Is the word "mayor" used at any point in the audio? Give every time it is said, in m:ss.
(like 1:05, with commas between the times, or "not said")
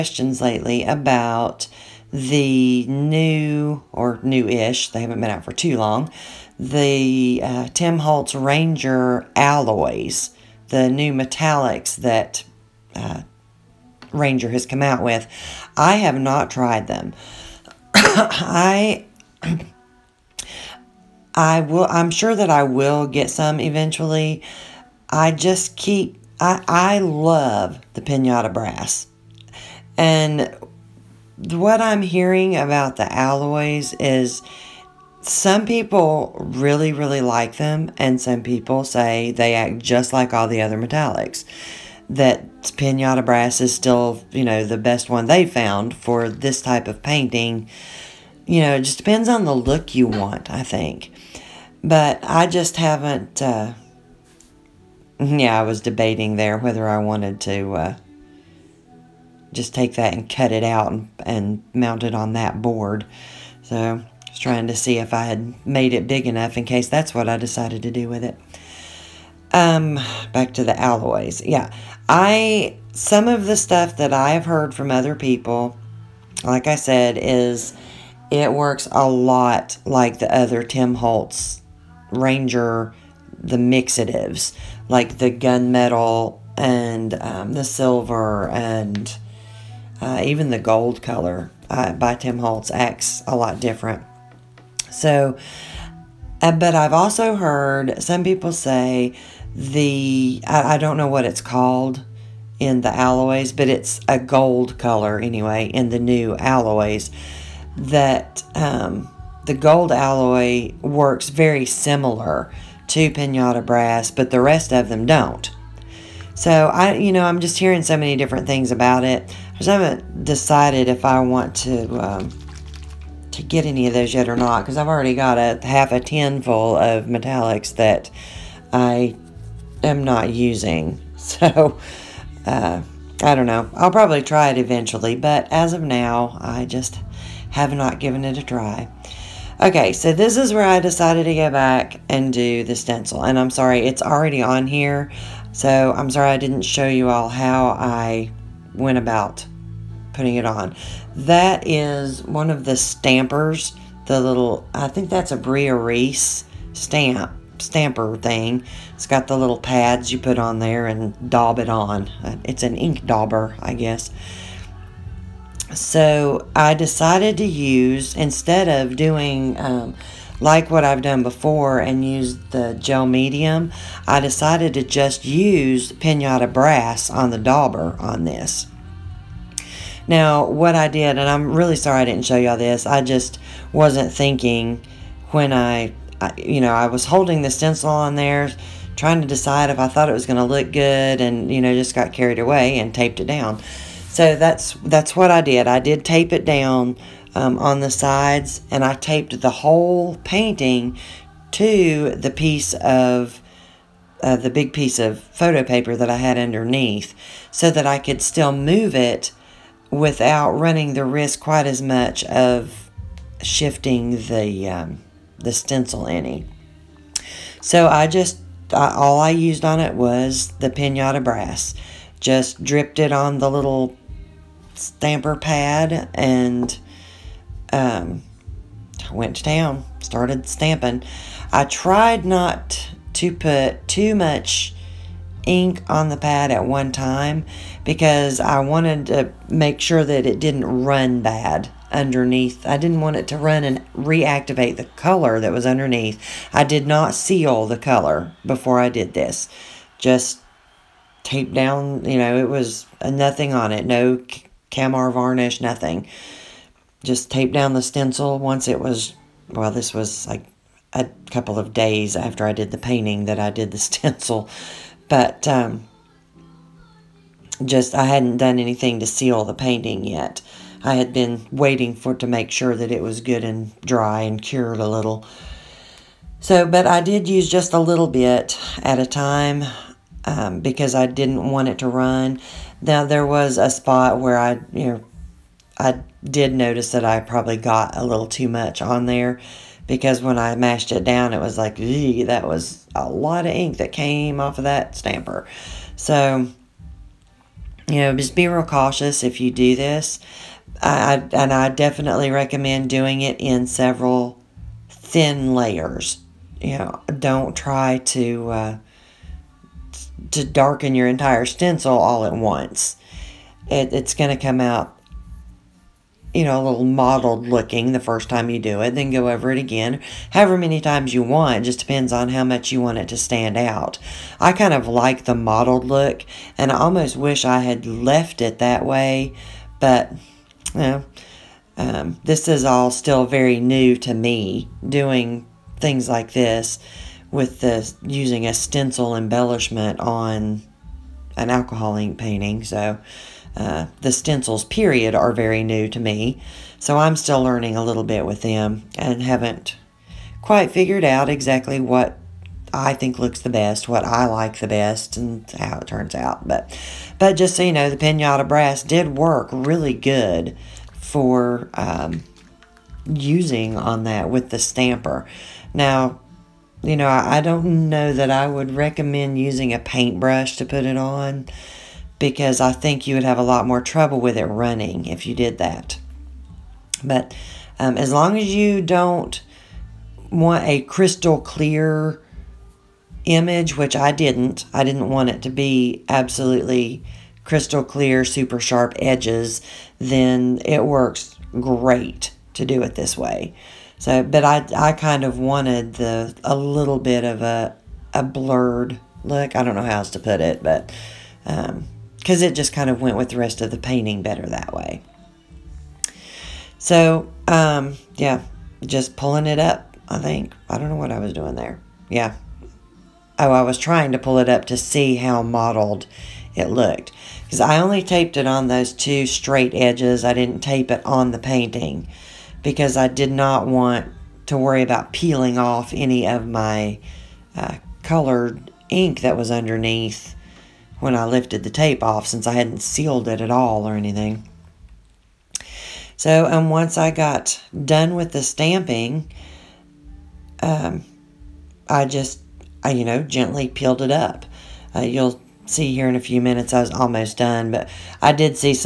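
not said.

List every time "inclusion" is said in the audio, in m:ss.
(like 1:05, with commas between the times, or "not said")
not said.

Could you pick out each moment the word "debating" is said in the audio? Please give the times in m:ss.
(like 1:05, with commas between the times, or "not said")
0:55.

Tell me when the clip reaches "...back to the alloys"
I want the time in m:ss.
1:10.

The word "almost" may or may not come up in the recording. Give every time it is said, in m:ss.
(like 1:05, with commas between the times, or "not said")
5:26, 7:26.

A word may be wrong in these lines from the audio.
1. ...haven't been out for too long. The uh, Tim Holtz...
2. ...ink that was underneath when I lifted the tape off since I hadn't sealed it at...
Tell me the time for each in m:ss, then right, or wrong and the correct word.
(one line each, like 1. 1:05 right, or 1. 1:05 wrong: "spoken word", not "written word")
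1. 0:04 right
2. 7:08 right.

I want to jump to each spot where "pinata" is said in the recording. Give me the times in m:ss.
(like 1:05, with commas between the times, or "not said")
0:28, 0:42, 1:53, 2:55, 3:40, 5:57.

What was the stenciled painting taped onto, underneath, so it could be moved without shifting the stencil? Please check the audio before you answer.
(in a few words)
photo paper.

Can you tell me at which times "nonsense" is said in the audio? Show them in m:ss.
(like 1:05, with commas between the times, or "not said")
not said.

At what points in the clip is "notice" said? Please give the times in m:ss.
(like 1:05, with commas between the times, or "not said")
4:46.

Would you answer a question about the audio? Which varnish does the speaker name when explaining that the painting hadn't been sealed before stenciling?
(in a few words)
Kamar varnish.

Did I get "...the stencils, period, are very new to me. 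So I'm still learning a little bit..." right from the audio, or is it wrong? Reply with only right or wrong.
right.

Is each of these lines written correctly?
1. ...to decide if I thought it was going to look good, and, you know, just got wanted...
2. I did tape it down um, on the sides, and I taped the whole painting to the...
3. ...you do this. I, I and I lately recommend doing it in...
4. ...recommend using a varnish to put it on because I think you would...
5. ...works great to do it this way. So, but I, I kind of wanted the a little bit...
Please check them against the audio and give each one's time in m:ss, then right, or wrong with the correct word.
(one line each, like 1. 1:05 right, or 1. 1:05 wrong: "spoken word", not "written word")
1. 3:09 wrong: "carried", not "wanted"
2. 3:15 right
3. 4:59 wrong: "definitely", not "lately"
4. 6:08 wrong: "paintbrush", not "varnish"
5. 6:30 right.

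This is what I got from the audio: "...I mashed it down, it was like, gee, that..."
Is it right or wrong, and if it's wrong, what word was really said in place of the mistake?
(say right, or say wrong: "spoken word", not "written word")
right.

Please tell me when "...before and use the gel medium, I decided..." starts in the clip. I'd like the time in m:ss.
2:51.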